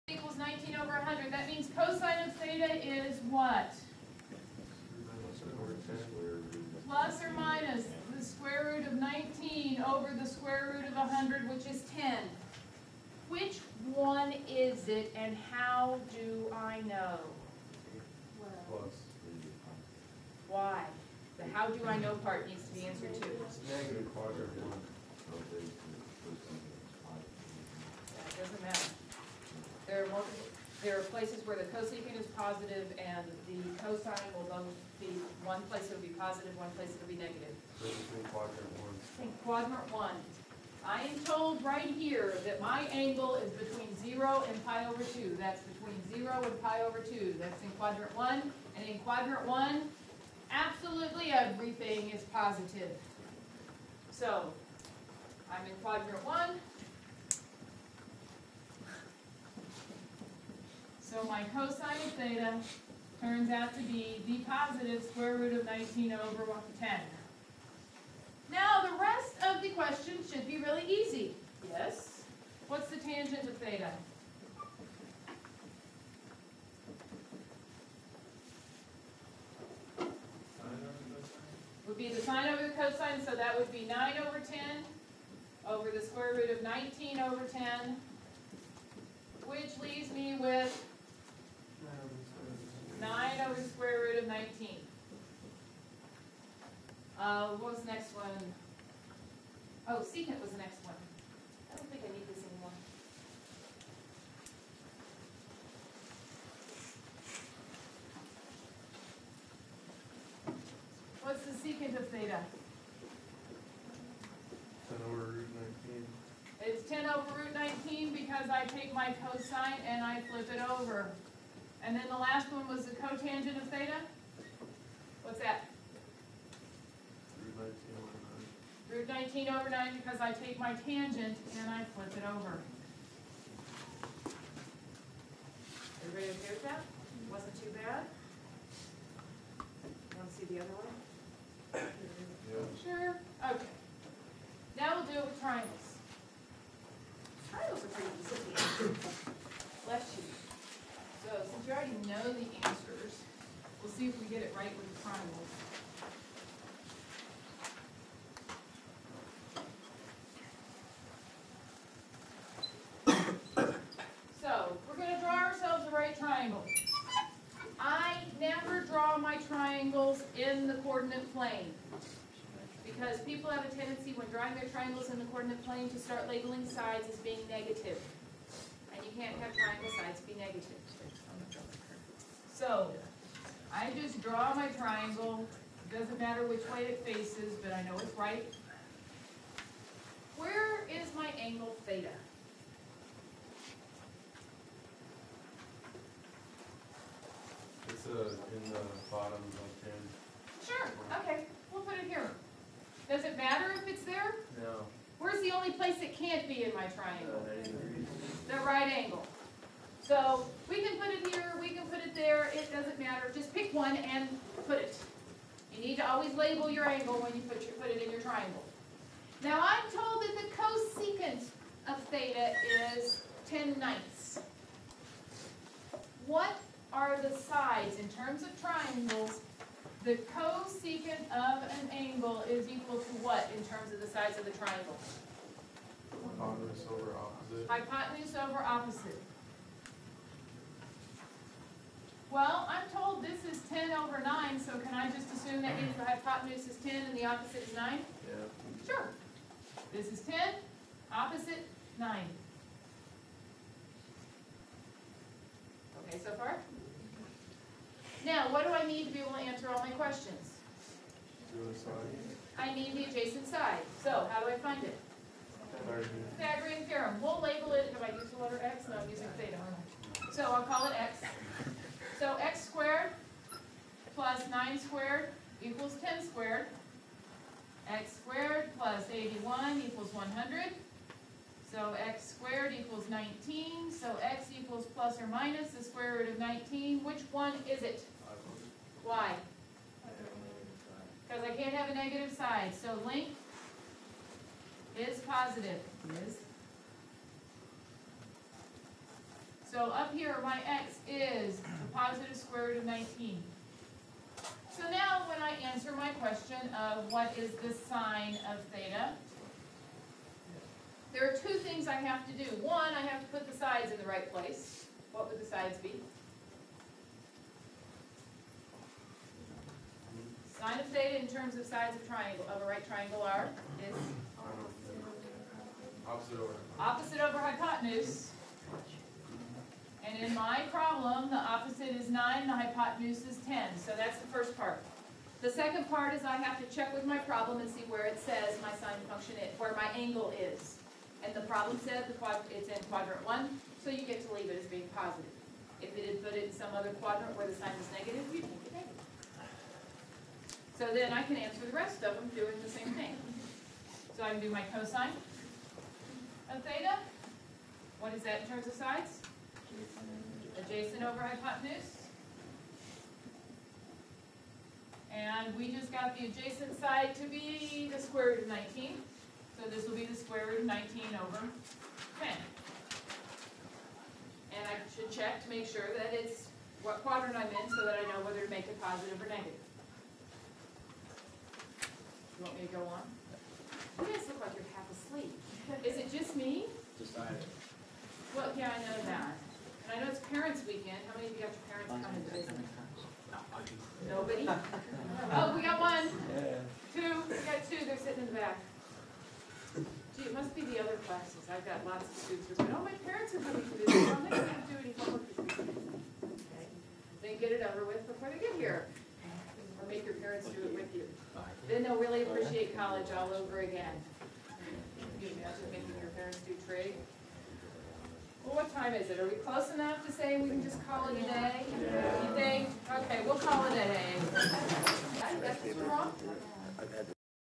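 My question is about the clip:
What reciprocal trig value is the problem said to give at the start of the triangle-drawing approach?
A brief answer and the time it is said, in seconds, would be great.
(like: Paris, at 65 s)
10/9, at 223 s.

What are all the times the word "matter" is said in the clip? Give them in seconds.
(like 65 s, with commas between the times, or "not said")
186 s, 212 s.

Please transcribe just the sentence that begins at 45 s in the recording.
That's between 0 and pi over 2.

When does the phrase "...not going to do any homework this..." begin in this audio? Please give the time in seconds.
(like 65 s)
404 s.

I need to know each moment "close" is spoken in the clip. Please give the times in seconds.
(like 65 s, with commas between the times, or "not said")
419 s.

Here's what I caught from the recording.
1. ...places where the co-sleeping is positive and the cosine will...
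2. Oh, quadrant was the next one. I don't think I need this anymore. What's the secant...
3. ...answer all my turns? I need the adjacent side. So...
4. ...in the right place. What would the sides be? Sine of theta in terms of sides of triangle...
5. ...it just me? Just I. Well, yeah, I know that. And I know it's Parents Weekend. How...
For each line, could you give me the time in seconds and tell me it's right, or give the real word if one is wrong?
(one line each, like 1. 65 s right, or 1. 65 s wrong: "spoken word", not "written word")
1. 31 s right
2. 99 s wrong: "secant", not "quadrant"
3. 259 s wrong: "questions", not "turns"
4. 313 s right
5. 385 s right.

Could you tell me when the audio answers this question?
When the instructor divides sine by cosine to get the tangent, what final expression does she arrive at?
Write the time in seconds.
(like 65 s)
93 s.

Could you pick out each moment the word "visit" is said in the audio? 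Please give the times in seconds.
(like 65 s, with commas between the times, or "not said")
392 s, 403 s.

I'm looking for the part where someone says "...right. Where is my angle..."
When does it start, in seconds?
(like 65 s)
188 s.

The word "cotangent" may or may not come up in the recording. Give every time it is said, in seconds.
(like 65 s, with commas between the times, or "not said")
122 s.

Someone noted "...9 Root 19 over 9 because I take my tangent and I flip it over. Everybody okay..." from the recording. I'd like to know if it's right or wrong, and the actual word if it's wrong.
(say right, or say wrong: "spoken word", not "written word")
right.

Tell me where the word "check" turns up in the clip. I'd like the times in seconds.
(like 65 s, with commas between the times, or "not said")
336 s, 375 s.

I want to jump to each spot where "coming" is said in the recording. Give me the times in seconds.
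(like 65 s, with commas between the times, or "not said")
391 s, 403 s.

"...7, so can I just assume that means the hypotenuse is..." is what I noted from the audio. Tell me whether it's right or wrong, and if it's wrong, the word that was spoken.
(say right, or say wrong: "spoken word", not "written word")
wrong: "9", not "7".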